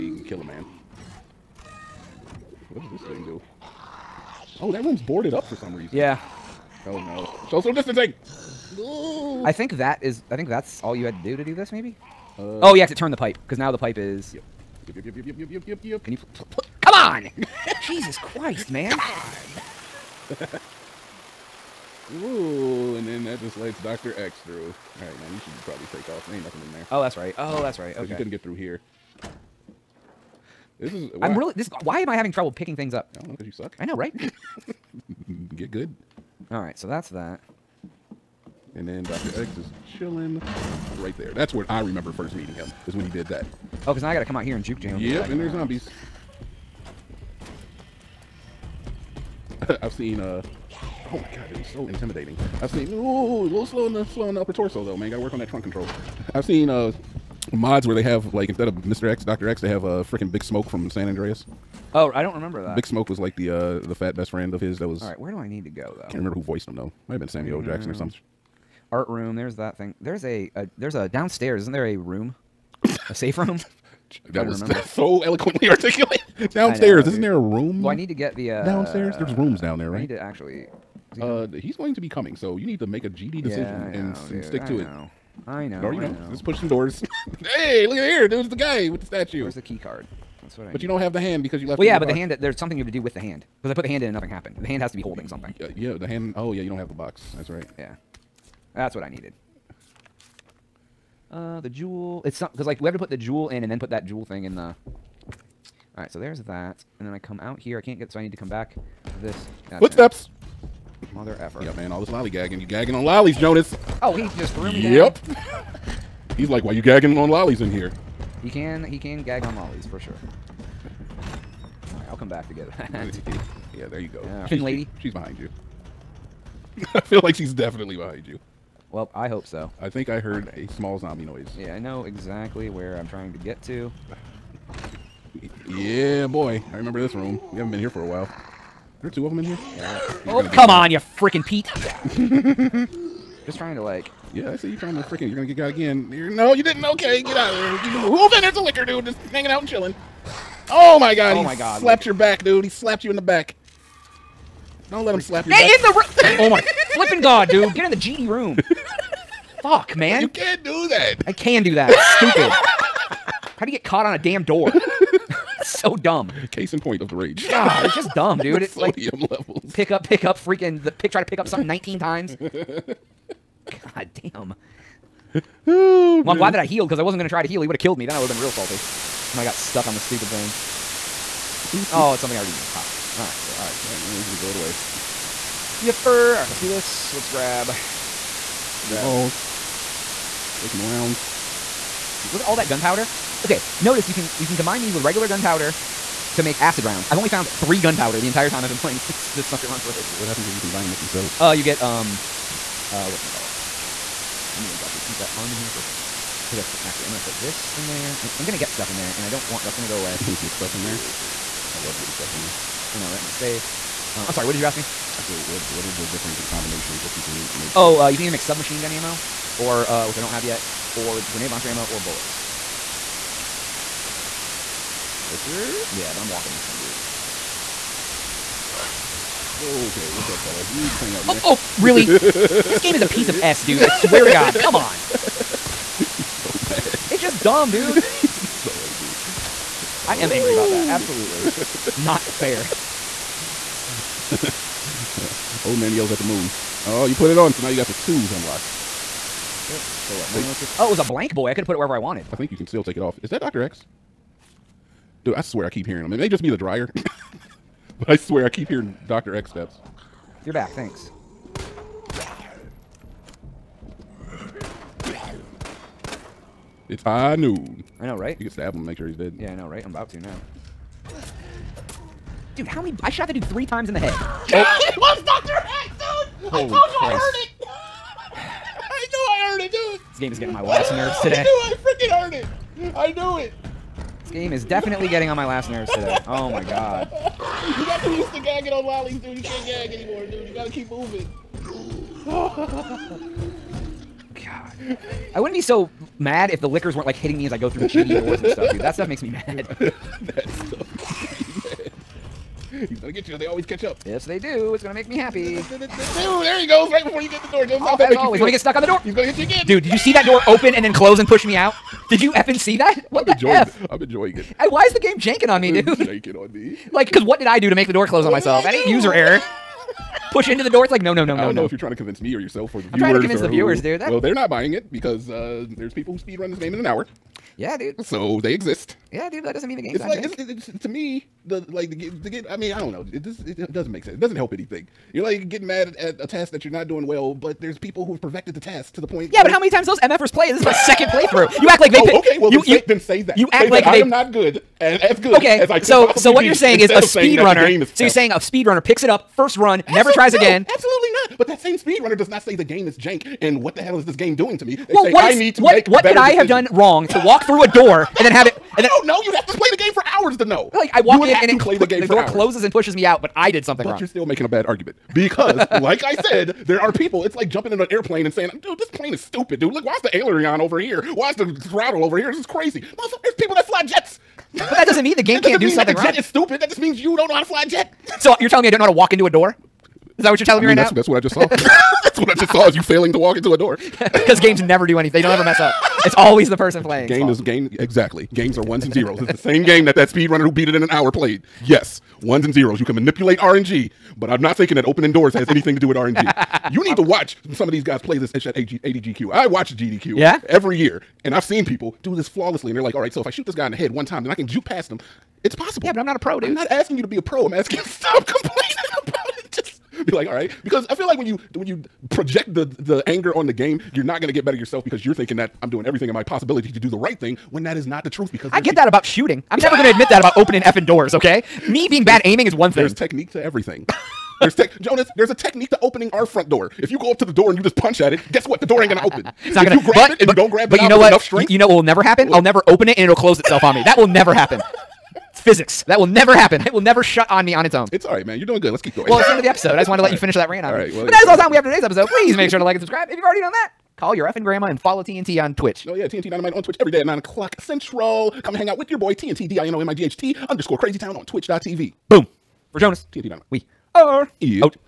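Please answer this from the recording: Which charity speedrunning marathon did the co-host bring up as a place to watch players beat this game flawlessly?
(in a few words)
AGDQ.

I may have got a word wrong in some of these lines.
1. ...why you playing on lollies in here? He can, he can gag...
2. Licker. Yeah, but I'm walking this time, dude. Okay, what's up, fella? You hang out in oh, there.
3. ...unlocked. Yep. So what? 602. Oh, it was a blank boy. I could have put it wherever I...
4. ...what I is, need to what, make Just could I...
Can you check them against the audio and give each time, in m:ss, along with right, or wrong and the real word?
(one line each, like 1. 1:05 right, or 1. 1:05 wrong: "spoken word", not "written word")
1. 1:56 wrong: "gagging", not "playing"
2. 3:45 right
3. 4:08 wrong: "102", not "602"
4. 5:55 wrong: "What", not "Just".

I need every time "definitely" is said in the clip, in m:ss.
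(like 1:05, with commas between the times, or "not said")
2:07, 4:44.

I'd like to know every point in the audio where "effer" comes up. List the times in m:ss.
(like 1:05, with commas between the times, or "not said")
1:51.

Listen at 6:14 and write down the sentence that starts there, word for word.
But that doesn't mean the game can't do something that the jet is stupid.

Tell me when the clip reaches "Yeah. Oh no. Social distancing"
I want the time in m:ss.
0:05.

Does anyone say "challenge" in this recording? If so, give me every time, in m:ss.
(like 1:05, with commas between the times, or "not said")
not said.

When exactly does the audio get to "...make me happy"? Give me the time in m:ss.
5:04.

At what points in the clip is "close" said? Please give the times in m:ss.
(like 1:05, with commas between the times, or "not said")
5:10, 5:18, 6:02, 7:13.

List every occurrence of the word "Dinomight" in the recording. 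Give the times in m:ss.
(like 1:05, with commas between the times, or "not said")
7:26, 7:33.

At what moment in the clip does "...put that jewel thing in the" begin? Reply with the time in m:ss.
1:43.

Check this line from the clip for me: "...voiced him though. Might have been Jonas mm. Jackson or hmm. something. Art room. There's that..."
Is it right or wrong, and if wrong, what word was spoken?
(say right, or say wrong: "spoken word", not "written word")
wrong: "Samuel", not "Jonas".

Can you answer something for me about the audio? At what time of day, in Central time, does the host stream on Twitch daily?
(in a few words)
9:00.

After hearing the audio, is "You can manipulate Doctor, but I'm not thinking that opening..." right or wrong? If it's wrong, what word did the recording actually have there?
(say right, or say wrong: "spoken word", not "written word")
wrong: "RNG", not "Doctor".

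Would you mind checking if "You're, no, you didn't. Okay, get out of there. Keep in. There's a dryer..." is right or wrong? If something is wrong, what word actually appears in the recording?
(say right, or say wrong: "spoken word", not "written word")
wrong: "licker", not "dryer".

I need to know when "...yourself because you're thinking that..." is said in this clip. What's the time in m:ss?
6:54.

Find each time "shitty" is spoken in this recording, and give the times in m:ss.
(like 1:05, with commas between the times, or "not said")
4:57.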